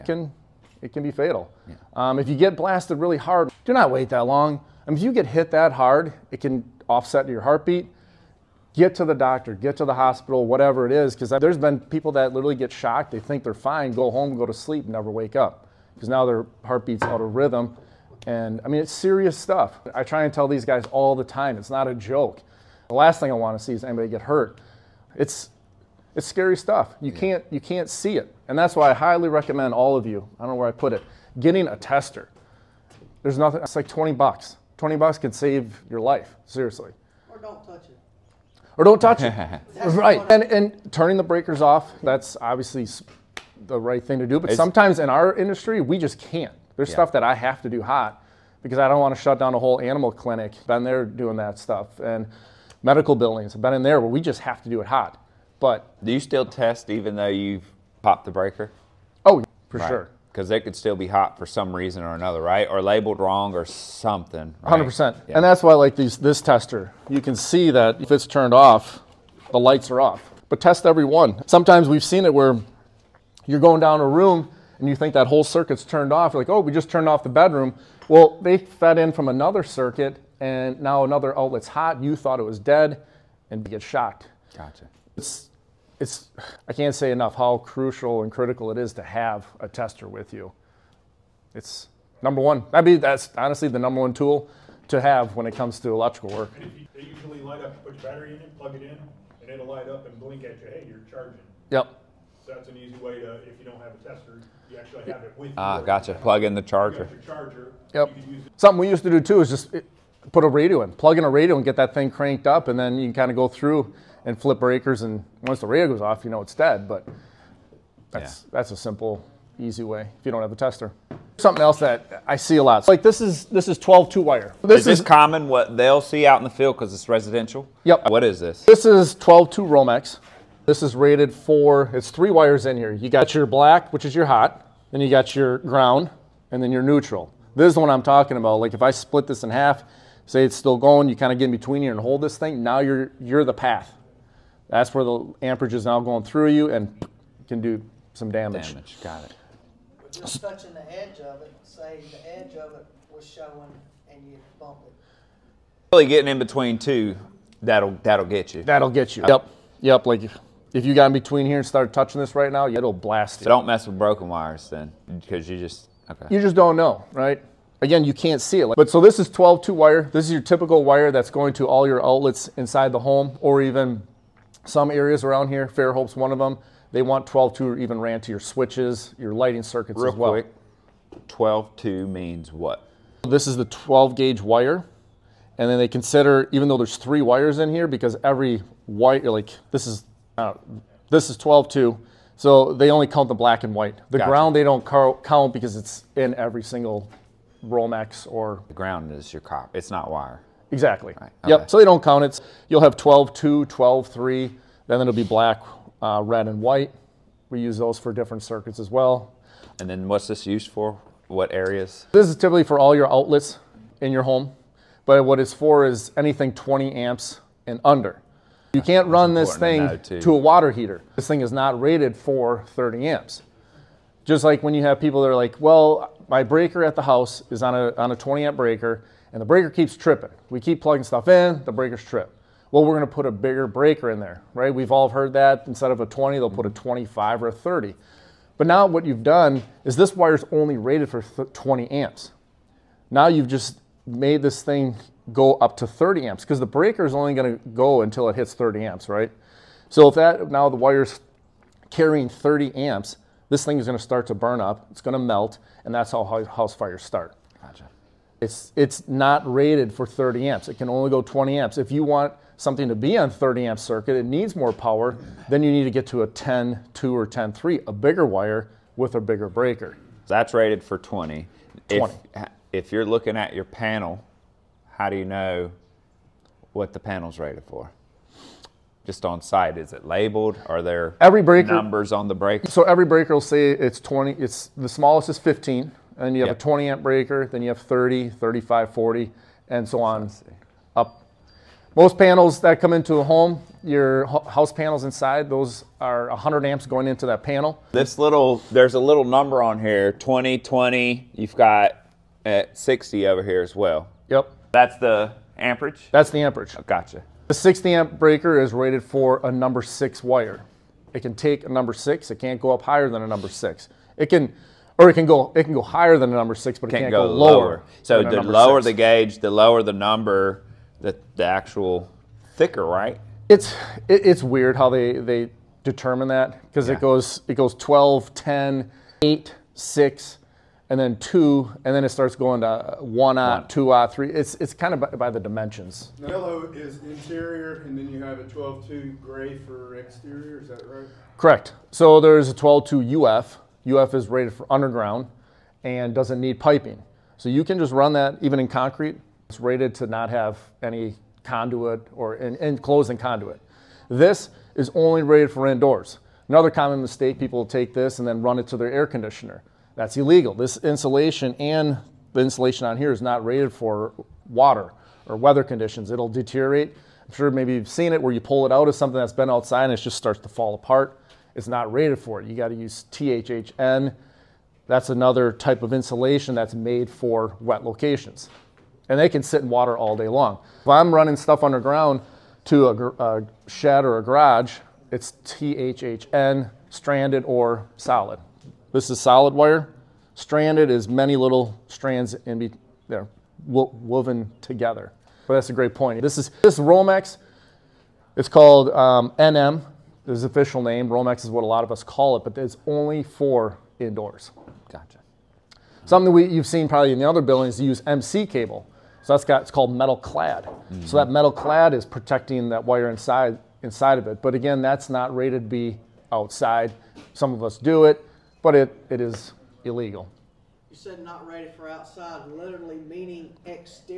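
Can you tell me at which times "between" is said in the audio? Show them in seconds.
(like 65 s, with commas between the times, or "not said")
141 s, 156 s, 161 s.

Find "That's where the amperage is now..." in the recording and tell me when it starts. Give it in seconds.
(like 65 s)
144 s.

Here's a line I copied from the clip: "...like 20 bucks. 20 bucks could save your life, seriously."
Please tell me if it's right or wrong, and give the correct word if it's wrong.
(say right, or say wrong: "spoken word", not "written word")
right.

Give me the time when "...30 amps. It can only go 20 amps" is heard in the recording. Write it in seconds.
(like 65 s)
260 s.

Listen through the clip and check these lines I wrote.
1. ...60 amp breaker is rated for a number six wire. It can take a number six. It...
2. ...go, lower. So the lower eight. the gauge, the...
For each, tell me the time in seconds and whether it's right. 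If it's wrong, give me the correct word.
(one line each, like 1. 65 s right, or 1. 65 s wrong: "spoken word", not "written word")
1. 307 s right
2. 317 s wrong: "six", not "eight".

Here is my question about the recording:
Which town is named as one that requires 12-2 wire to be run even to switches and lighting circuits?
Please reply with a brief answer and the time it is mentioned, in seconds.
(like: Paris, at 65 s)
Fairhope, at 175 s.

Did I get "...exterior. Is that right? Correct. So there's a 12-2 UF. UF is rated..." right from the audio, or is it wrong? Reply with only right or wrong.
right.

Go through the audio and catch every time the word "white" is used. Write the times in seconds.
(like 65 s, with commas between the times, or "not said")
193 s, 206 s.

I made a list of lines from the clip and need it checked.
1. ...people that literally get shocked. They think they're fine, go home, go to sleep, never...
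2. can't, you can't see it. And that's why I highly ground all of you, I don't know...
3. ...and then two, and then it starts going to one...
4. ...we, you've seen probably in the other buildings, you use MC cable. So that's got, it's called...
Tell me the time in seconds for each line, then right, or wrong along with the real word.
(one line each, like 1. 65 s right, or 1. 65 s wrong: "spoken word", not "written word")
1. 11 s right
2. 27 s wrong: "recommend", not "ground"
3. 330 s right
4. 406 s right.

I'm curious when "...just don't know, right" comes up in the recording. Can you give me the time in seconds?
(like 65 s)
166 s.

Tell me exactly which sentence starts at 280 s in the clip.
Are there every breaker, numbers on the breaker?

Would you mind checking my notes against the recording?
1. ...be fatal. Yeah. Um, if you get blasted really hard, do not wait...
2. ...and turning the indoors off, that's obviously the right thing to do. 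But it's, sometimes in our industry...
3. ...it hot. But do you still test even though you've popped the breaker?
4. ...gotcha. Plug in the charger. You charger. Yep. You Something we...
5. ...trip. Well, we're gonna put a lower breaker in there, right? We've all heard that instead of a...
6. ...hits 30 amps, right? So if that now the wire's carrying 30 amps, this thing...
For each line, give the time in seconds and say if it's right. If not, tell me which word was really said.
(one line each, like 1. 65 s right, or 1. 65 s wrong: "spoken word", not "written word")
1. 1 s right
2. 40 s wrong: "breakers", not "indoors"
3. 54 s right
4. 105 s right
5. 232 s wrong: "bigger", not "lower"
6. 248 s right.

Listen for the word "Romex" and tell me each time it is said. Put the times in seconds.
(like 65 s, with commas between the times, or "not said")
129 s, 197 s, 396 s, 401 s.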